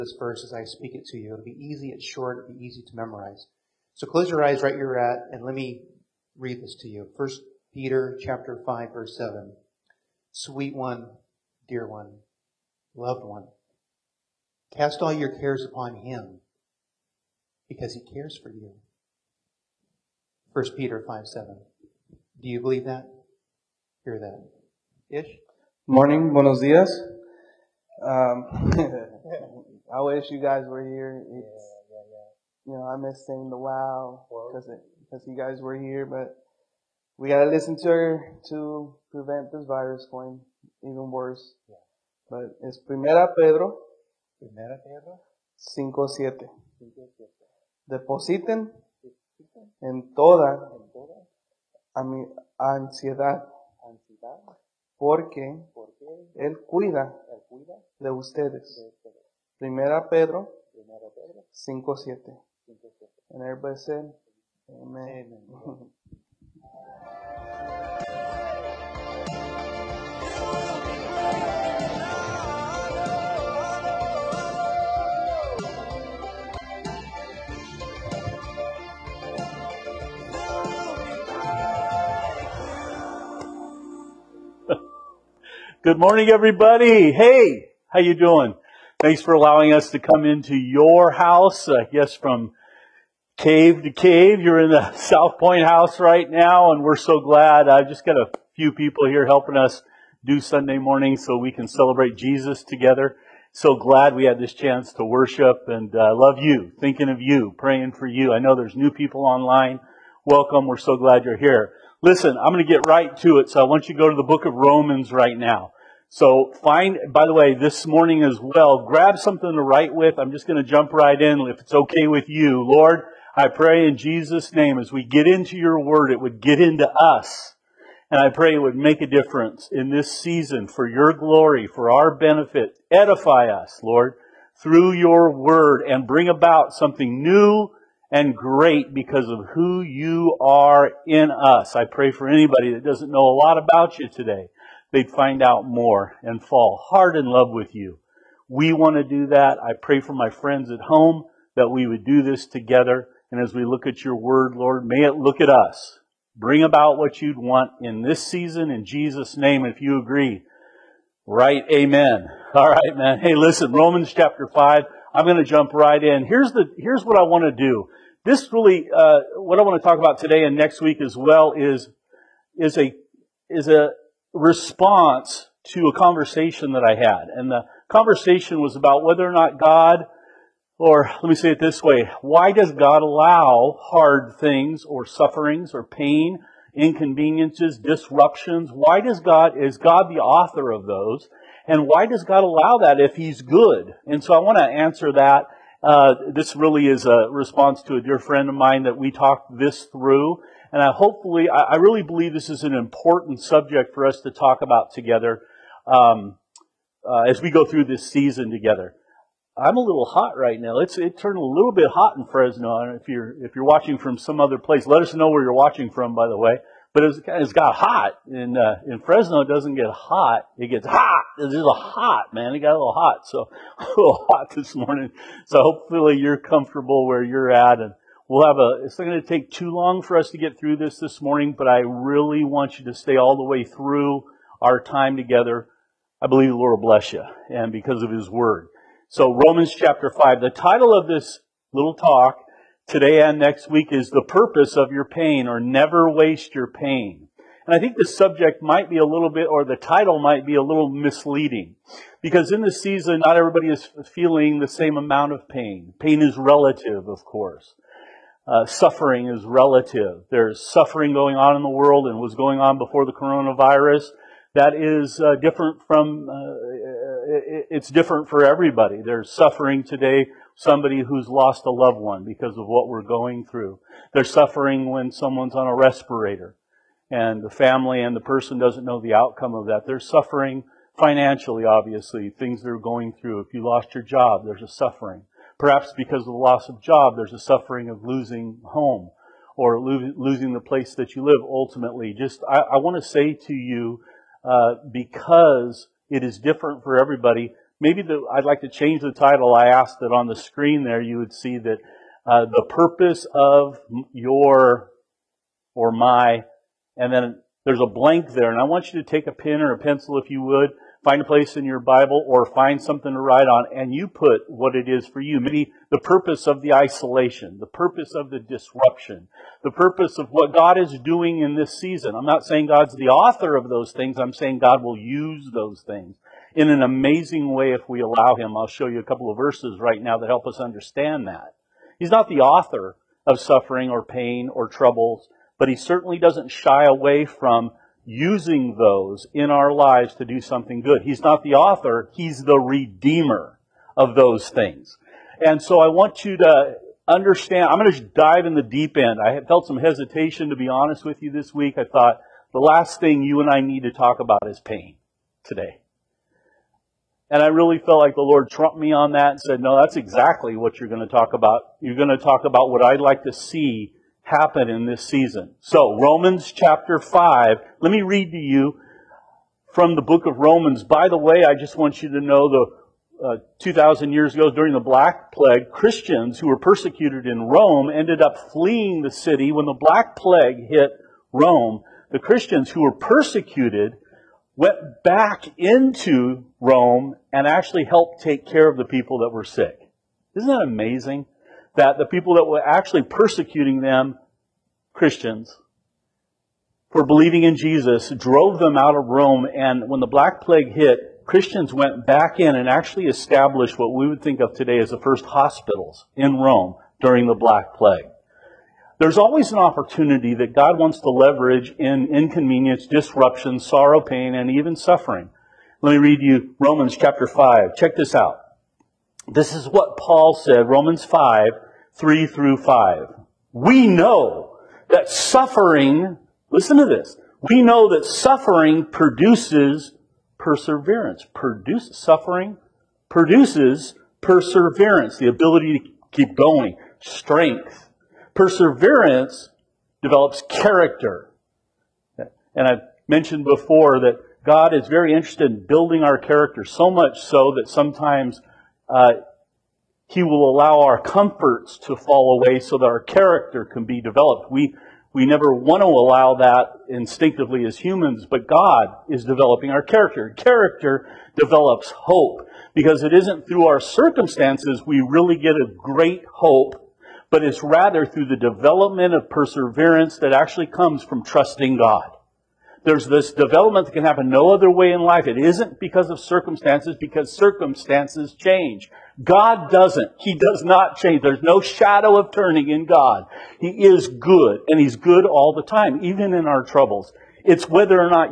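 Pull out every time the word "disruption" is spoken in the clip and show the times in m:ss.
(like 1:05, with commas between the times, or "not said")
3:07, 5:18, 6:52.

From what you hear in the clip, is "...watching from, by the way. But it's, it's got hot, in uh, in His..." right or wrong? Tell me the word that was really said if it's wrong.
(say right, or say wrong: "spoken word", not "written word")
wrong: "Fresno", not "His".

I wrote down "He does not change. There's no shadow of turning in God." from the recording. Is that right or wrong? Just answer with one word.
right.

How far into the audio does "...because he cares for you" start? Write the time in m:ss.
0:17.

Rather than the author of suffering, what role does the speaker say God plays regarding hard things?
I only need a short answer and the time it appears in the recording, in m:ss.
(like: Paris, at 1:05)
redeemer, at 5:42.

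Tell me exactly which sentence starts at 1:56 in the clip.
So find, by the way, this morning as well, grab something to write with.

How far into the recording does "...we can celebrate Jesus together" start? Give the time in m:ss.
1:41.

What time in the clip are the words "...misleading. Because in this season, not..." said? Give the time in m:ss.
4:10.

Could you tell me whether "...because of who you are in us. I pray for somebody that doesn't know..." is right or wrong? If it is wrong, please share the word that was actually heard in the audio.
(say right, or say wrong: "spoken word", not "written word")
wrong: "anybody", not "somebody".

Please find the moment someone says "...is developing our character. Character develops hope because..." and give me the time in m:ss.
7:39.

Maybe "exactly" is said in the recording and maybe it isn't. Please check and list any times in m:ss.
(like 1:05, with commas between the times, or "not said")
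5:59.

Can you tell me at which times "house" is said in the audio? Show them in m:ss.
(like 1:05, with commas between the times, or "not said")
1:31, 1:35.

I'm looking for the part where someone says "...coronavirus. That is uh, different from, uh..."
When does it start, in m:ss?
4:23.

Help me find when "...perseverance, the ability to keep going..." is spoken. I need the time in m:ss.
7:14.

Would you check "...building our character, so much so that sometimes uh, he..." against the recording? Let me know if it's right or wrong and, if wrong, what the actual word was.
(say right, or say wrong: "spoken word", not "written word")
right.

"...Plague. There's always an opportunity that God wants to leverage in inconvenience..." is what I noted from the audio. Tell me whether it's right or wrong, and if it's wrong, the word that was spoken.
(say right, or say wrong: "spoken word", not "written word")
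right.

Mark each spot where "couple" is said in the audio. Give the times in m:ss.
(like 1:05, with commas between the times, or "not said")
5:29.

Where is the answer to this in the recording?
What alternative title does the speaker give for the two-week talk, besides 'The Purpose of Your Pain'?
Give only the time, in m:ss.
4:05.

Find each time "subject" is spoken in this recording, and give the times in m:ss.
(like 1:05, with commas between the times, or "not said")
3:23, 4:08.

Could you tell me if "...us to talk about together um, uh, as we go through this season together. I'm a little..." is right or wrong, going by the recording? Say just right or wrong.
right.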